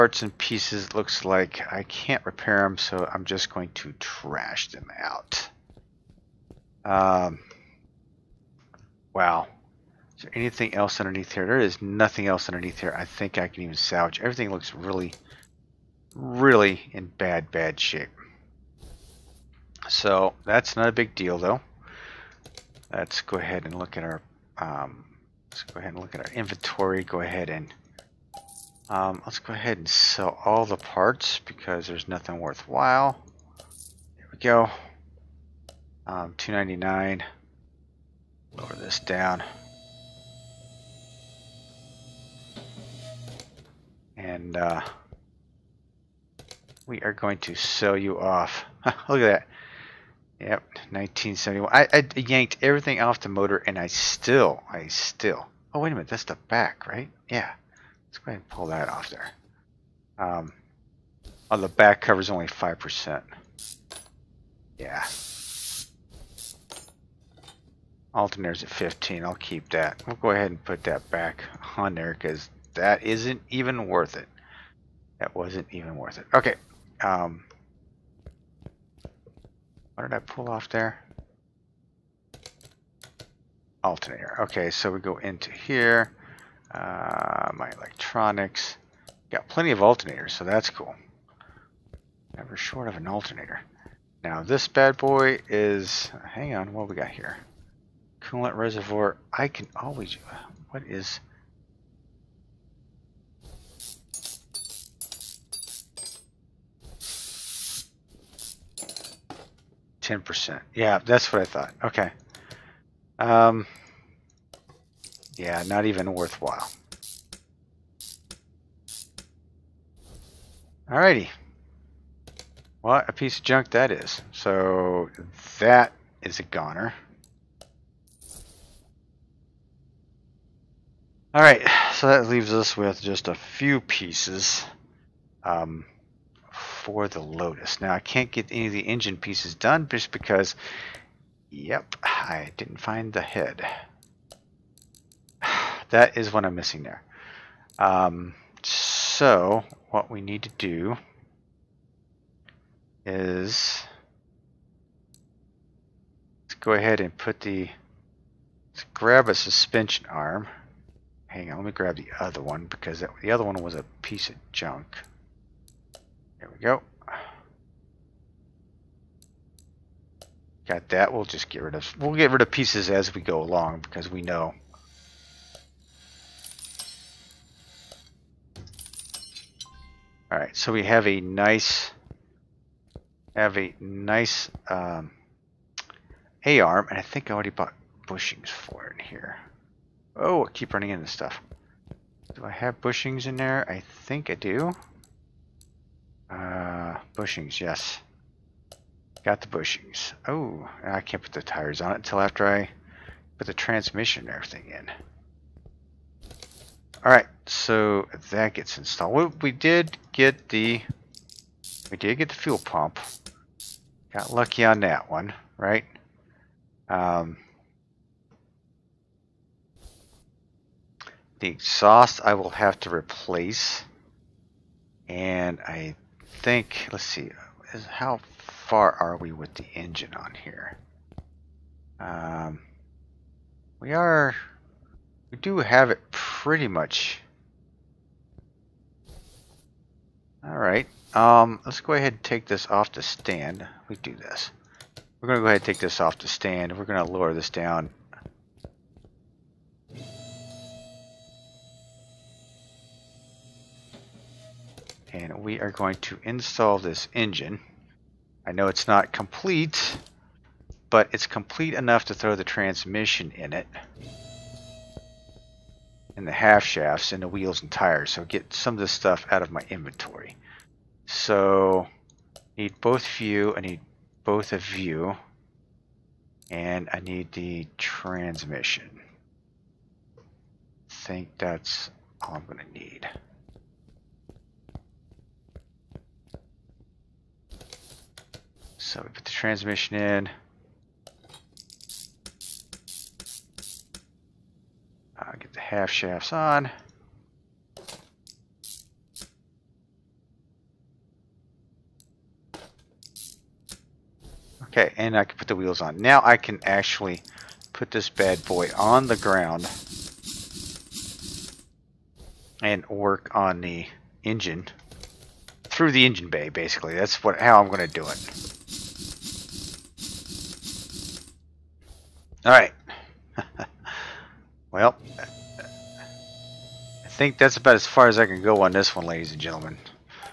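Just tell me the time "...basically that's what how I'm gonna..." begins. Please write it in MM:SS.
05:16.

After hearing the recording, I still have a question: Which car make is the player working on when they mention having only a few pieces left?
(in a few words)
Lotus.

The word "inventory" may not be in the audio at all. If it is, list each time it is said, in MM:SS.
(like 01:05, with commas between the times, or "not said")
00:26, 04:29.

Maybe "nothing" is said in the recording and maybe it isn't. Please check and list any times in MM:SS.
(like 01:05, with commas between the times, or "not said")
00:11, 00:32.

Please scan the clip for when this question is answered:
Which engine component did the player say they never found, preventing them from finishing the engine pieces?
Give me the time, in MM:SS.
02:23.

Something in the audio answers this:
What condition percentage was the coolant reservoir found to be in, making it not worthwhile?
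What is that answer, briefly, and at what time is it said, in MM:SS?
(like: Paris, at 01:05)
10%, at 01:50.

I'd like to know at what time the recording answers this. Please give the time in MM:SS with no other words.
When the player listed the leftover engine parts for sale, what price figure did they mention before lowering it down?
00:36.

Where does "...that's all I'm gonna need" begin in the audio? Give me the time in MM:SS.
04:41.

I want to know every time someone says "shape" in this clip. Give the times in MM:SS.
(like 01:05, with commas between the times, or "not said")
00:17.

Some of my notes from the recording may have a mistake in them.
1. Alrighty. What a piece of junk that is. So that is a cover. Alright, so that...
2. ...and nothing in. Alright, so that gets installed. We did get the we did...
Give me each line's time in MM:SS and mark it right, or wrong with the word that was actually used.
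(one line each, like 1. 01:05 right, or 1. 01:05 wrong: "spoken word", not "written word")
1. 02:00 wrong: "goner", not "cover"
2. 03:24 wrong: "everything", not "nothing".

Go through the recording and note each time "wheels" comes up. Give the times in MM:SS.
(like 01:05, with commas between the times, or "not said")
04:27, 05:05.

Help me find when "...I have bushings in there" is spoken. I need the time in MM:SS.
03:12.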